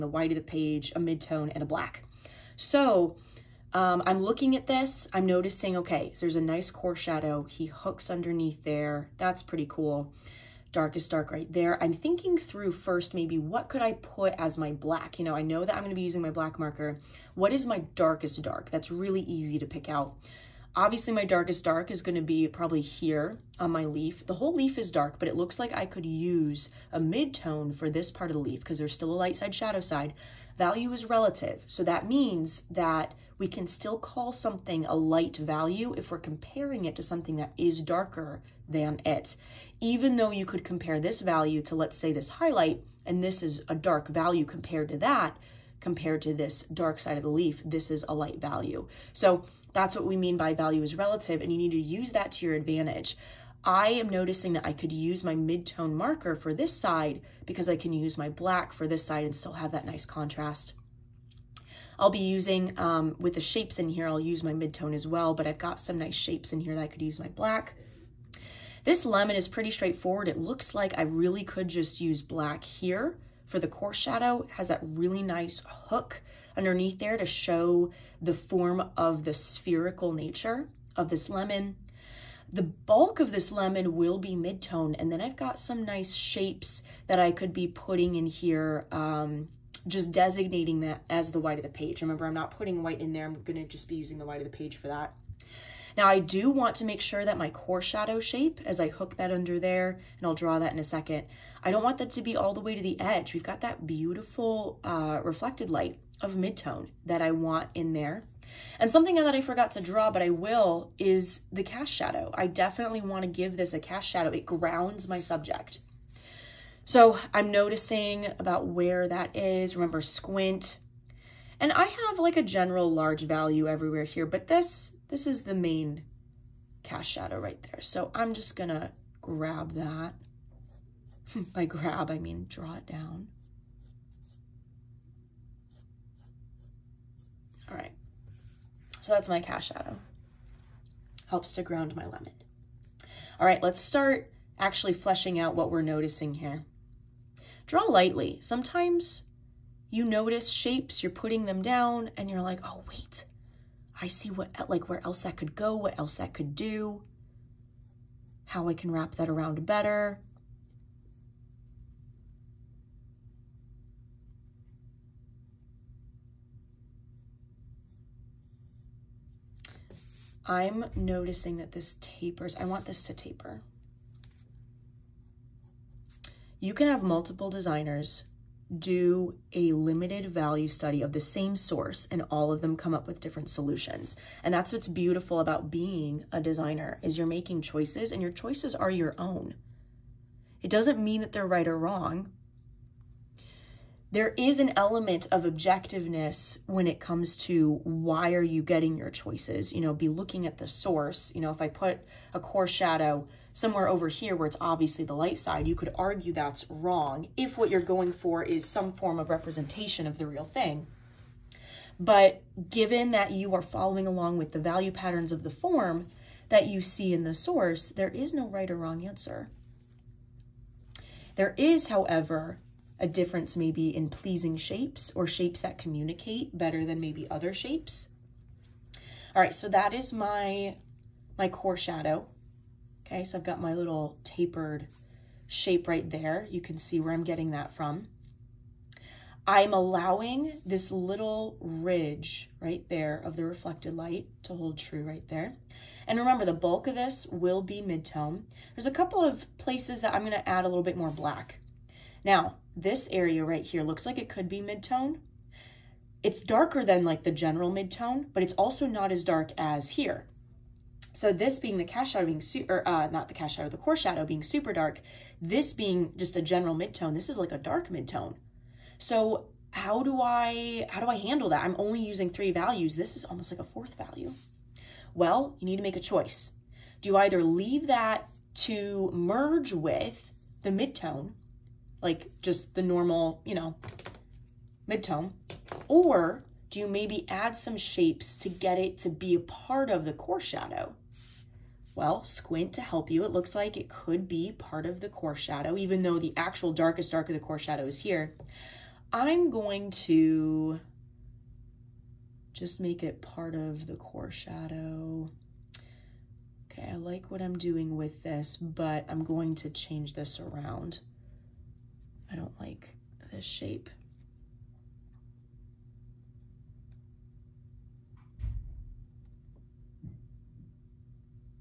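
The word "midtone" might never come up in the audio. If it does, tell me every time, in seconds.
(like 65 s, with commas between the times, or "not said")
0 s, 106 s, 284 s.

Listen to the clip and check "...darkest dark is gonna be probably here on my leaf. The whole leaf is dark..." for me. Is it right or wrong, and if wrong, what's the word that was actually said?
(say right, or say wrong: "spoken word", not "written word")
right.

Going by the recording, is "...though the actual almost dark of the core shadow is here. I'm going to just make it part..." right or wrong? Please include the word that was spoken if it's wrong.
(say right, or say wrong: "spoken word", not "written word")
wrong: "darkest", not "almost".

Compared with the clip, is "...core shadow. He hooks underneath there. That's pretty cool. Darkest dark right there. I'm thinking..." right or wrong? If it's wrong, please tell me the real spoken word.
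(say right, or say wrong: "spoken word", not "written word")
right.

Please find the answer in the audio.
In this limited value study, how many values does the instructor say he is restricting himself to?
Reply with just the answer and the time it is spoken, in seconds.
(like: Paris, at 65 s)
3, at 272 s.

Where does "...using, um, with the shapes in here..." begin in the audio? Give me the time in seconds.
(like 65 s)
62 s.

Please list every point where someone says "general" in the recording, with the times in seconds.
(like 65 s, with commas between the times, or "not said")
122 s, 257 s, 266 s.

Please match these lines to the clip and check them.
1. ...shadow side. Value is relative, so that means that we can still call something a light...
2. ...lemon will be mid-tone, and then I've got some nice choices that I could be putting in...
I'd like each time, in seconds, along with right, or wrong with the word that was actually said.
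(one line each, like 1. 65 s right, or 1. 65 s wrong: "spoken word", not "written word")
1. 29 s right
2. 83 s wrong: "shapes", not "choices".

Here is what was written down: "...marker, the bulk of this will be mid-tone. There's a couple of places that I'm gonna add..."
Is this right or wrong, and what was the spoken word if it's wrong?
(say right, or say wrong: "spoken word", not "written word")
wrong: "remember", not "marker".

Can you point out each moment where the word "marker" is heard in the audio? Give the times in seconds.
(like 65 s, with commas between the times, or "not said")
16 s, 55 s.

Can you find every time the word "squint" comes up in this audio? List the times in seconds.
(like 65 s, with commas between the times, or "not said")
119 s, 292 s.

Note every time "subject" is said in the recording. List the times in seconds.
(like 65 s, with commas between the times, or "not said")
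115 s.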